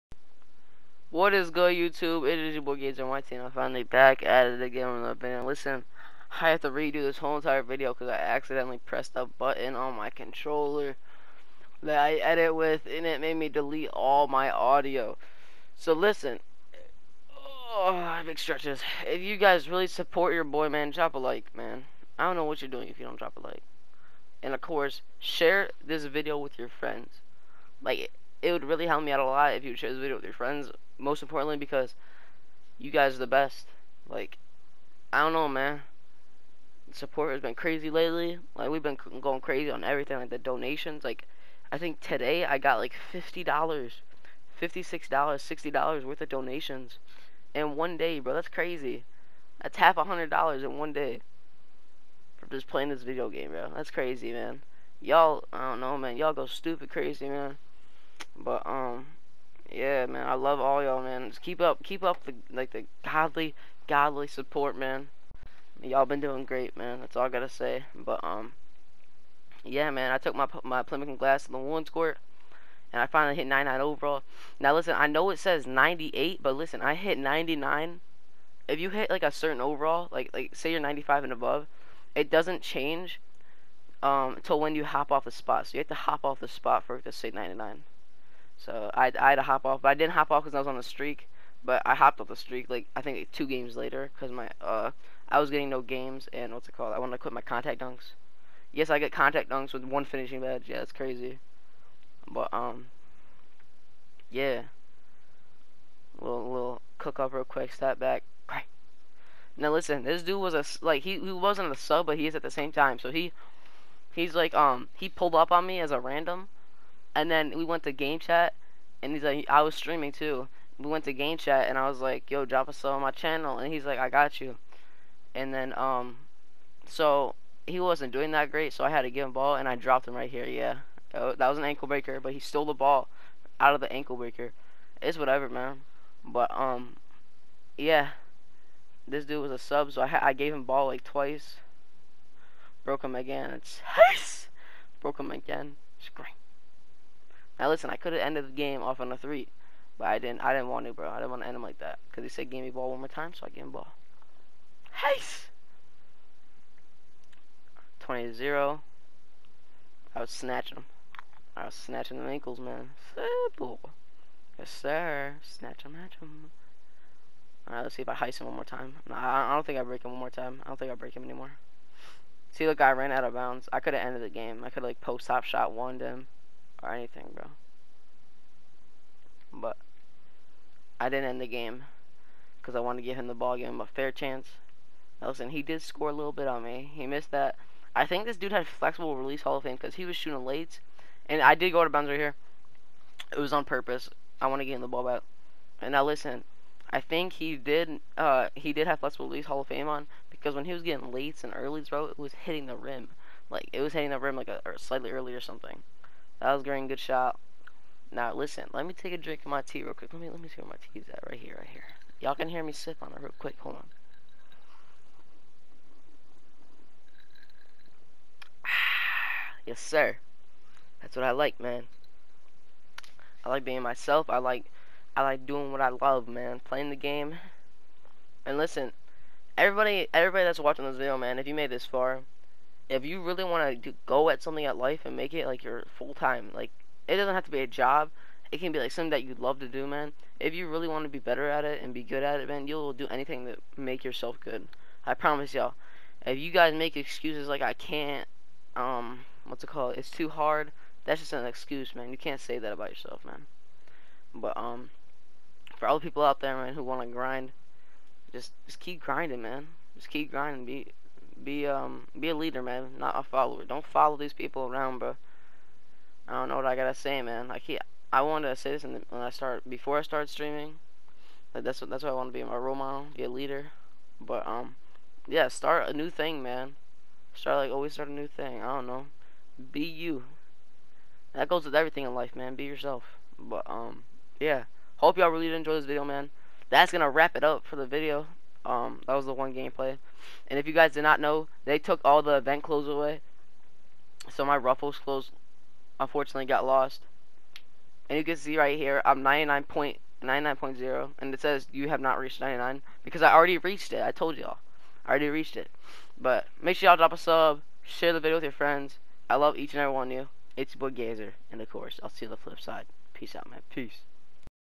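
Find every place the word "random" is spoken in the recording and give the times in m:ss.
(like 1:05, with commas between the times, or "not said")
1:55.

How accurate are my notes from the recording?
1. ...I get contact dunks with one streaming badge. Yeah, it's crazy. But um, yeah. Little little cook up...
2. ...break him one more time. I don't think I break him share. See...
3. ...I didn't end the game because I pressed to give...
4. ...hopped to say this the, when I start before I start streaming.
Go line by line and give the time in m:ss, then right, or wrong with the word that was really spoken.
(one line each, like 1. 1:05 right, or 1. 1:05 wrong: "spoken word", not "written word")
1. 1:38 wrong: "finishing", not "streaming"
2. 2:49 wrong: "anymore", not "share"
3. 3:00 wrong: "wanted", not "pressed"
4. 4:28 wrong: "wanted", not "hopped".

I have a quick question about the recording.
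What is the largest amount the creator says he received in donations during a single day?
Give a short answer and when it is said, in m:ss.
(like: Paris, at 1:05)
$60, at 0:45.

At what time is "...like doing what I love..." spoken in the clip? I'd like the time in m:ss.
3:45.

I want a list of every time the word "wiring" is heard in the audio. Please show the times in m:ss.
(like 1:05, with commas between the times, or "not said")
not said.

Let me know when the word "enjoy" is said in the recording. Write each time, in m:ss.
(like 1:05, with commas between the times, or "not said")
4:45.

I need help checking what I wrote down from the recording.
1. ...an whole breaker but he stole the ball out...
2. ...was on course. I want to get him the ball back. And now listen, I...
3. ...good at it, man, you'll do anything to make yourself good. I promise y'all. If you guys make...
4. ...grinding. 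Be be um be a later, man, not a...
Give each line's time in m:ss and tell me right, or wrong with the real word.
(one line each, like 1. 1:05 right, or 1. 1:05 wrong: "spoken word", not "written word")
1. 2:11 wrong: "ankle", not "whole"
2. 3:13 wrong: "purpose", not "course"
3. 4:02 right
4. 4:20 wrong: "leader", not "later".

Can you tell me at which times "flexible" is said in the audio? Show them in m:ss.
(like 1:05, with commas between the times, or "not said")
3:08, 3:19.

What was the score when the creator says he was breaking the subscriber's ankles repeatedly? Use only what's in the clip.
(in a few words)
20 to 0.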